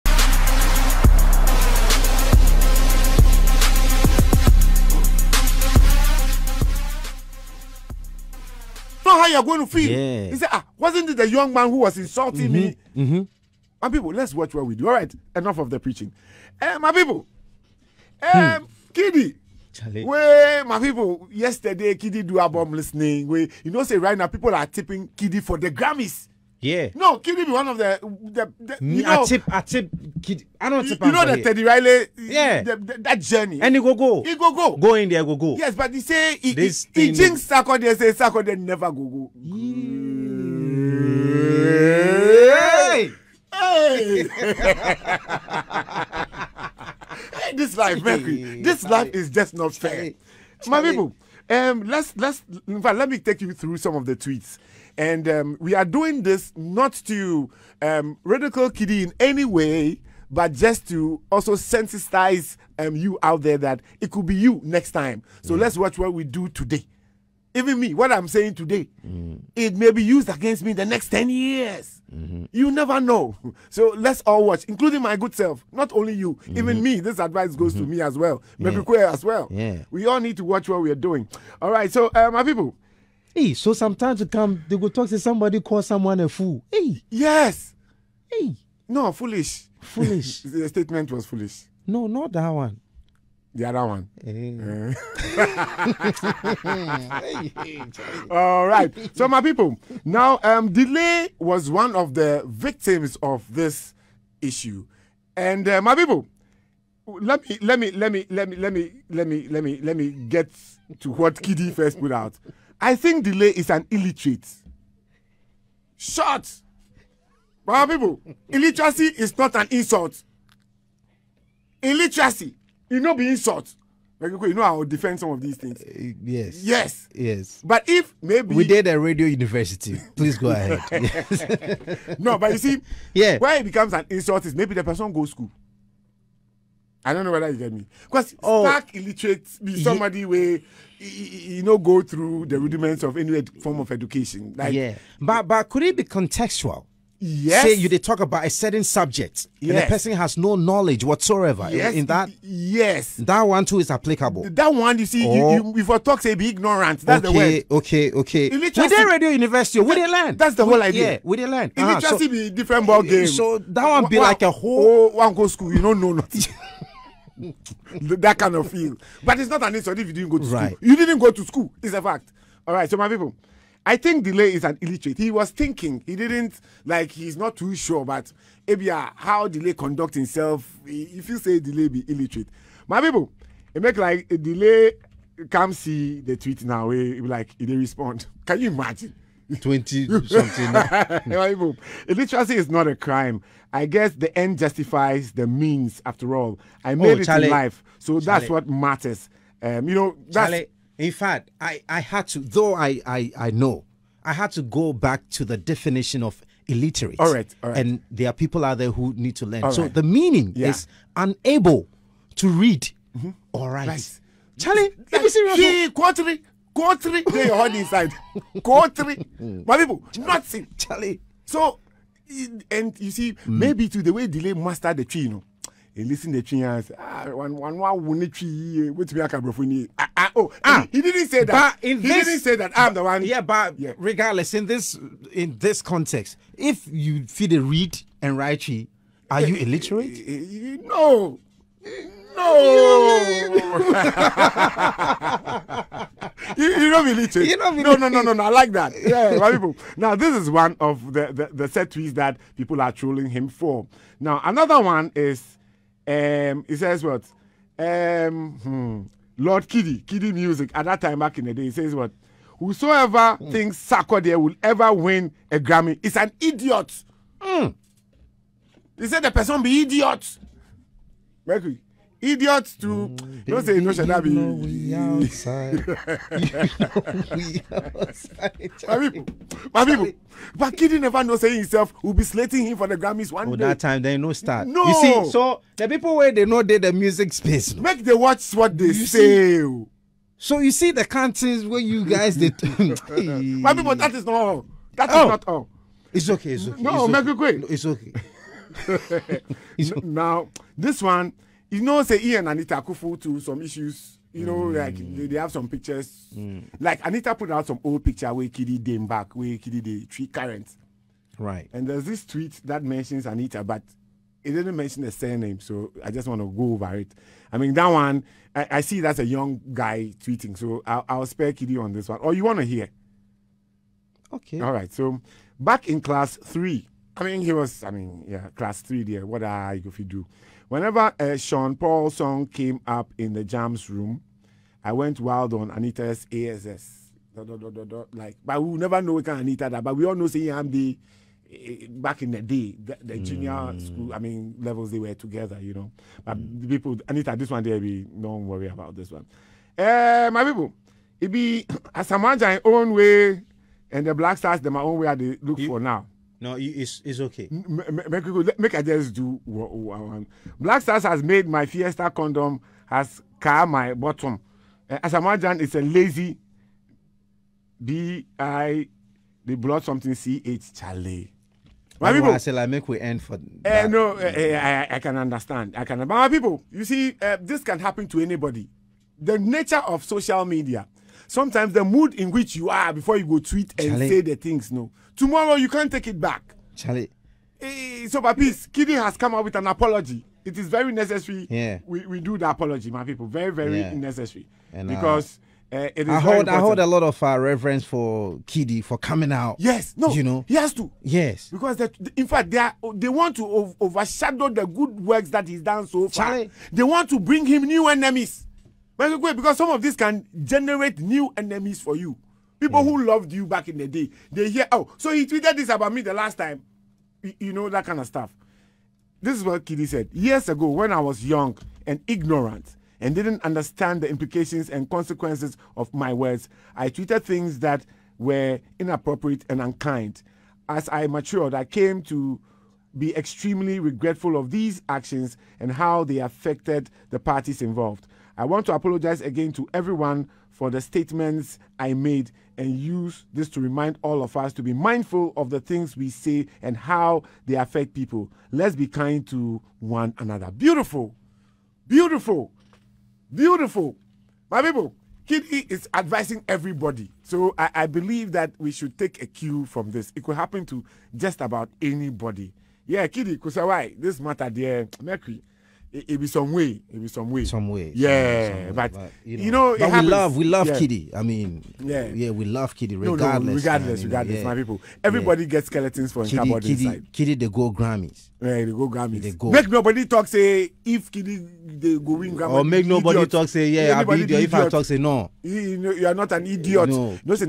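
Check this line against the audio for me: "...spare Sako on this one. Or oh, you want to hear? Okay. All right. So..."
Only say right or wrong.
wrong.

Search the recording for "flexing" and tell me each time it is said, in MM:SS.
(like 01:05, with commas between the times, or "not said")
not said.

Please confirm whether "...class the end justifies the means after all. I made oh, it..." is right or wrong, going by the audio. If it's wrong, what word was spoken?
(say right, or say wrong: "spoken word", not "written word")
wrong: "guess", not "class".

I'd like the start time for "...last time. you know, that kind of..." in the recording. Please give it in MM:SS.
06:56.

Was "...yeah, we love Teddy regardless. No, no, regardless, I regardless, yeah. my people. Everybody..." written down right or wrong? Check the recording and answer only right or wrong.
wrong.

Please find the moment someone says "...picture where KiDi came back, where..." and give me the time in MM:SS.
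05:08.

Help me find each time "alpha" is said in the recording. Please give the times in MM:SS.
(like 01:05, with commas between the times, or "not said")
not said.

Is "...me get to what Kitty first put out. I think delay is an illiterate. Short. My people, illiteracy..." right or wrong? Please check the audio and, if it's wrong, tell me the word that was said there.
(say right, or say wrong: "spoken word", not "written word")
wrong: "KiDi", not "Kitty".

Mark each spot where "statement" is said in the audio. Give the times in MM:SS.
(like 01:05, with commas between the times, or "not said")
01:30, 07:20.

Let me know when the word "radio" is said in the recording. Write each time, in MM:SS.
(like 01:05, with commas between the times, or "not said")
02:08, 02:39.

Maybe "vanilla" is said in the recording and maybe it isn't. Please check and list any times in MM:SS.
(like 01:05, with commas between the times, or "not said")
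not said.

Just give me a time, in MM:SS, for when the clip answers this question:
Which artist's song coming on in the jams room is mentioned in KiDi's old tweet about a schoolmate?
05:31.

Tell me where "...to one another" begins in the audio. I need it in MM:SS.
07:29.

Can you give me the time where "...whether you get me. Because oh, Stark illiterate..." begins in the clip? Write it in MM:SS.
02:17.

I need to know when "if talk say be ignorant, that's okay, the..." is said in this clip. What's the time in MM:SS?
02:35.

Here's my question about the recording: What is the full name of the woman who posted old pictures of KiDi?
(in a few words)
Anita Akuffo.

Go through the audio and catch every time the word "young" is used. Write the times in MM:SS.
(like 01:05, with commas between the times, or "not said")
00:11, 05:19, 07:01.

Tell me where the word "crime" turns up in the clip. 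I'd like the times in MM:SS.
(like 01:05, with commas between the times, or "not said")
03:12.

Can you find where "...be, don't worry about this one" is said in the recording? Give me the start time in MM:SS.
05:47.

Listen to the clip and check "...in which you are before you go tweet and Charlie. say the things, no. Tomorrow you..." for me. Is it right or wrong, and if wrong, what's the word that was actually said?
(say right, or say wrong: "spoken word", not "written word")
right.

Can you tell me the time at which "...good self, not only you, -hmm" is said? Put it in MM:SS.
01:15.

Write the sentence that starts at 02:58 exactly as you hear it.
But Ebia, uh, how delay conduct himself?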